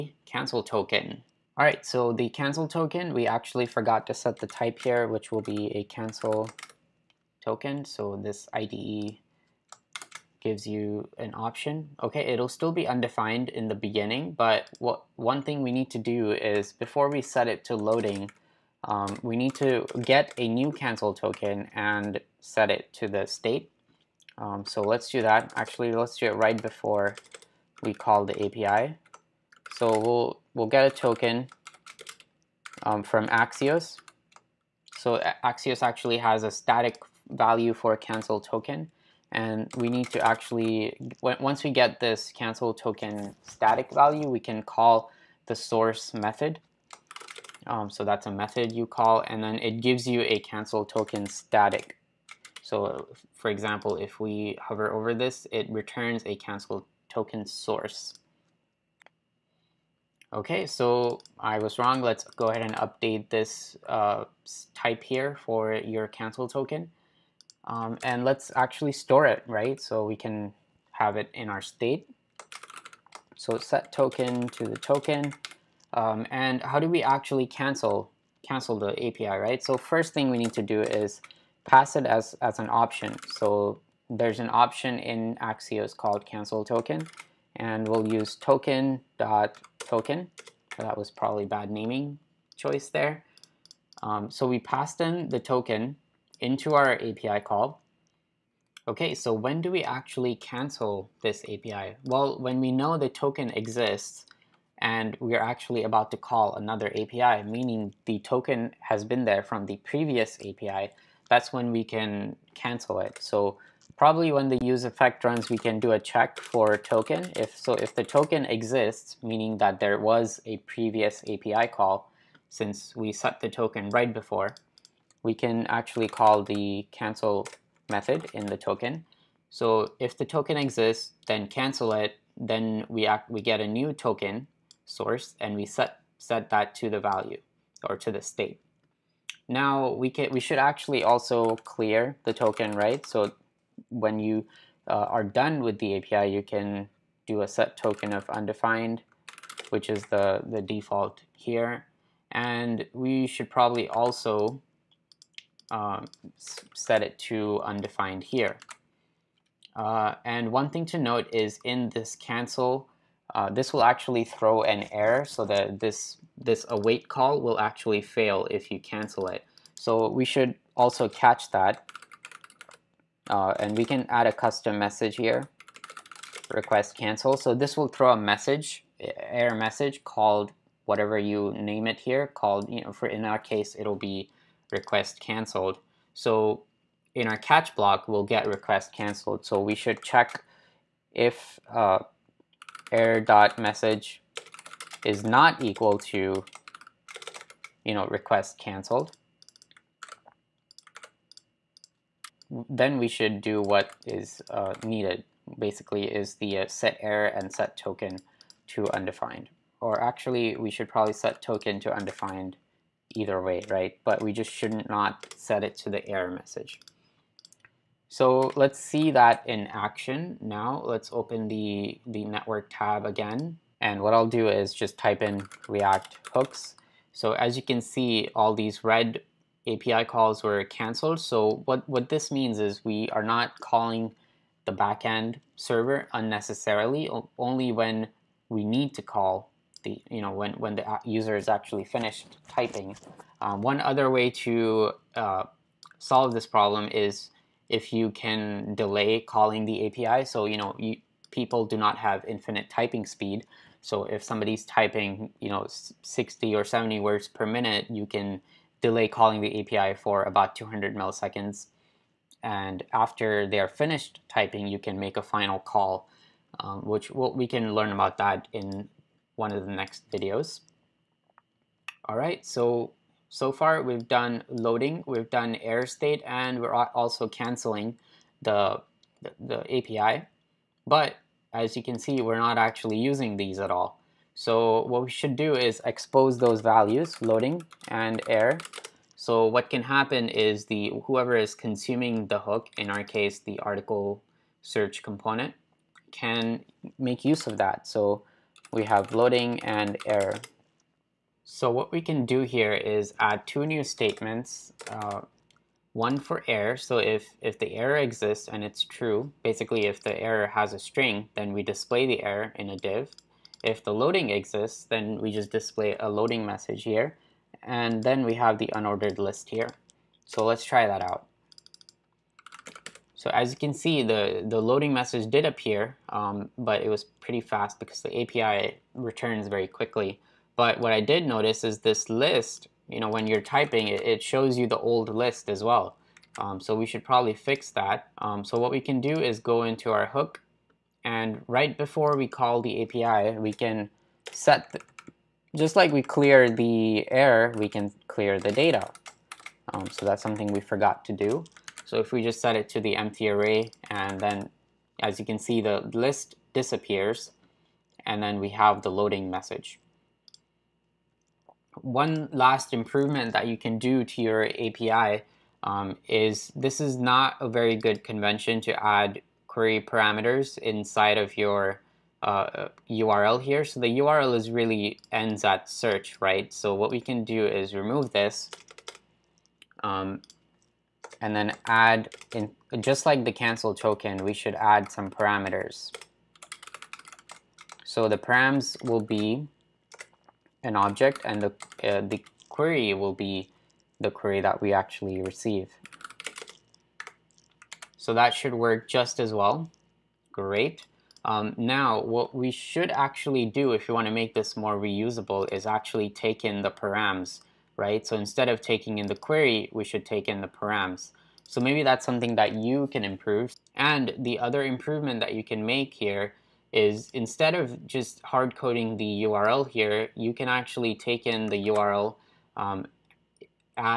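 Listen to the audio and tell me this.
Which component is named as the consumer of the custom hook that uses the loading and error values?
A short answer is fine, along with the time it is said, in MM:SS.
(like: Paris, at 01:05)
article search component, at 04:53.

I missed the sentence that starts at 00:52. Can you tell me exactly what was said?
So for example, if we hover over this, it returns a cancel token source.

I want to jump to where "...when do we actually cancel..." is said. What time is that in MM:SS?
01:39.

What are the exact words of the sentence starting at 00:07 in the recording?
So this IDE gives you an option.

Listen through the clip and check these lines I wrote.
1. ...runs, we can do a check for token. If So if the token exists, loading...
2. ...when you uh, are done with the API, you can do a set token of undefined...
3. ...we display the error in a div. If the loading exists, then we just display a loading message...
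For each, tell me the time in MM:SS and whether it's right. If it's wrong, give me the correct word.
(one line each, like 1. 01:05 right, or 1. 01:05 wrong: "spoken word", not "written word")
1. 01:55 wrong: "meaning", not "loading"
2. 02:23 right
3. 05:11 right.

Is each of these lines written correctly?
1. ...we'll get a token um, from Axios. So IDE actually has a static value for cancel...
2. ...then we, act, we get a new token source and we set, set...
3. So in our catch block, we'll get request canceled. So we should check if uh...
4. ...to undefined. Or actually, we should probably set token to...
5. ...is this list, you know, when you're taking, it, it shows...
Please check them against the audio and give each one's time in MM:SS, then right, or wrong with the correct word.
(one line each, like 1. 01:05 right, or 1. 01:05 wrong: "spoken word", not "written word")
1. 00:30 wrong: "Axios", not "IDE"
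2. 02:12 right
3. 03:06 right
4. 03:28 right
5. 05:31 wrong: "typing", not "taking".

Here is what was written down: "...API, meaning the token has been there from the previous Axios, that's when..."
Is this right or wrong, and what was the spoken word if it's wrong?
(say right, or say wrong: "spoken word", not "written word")
wrong: "API", not "Axios".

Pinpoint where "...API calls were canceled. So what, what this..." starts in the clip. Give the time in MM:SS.
03:49.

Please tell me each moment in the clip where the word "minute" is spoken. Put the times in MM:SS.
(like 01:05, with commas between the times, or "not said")
04:17.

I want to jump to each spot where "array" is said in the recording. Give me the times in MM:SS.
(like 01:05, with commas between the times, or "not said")
05:53.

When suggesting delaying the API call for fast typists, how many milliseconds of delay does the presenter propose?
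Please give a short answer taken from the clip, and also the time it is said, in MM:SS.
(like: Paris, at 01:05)
200, at 04:20.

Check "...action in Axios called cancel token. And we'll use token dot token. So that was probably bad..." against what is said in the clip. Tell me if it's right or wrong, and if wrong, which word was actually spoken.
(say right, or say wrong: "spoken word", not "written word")
wrong: "option", not "action".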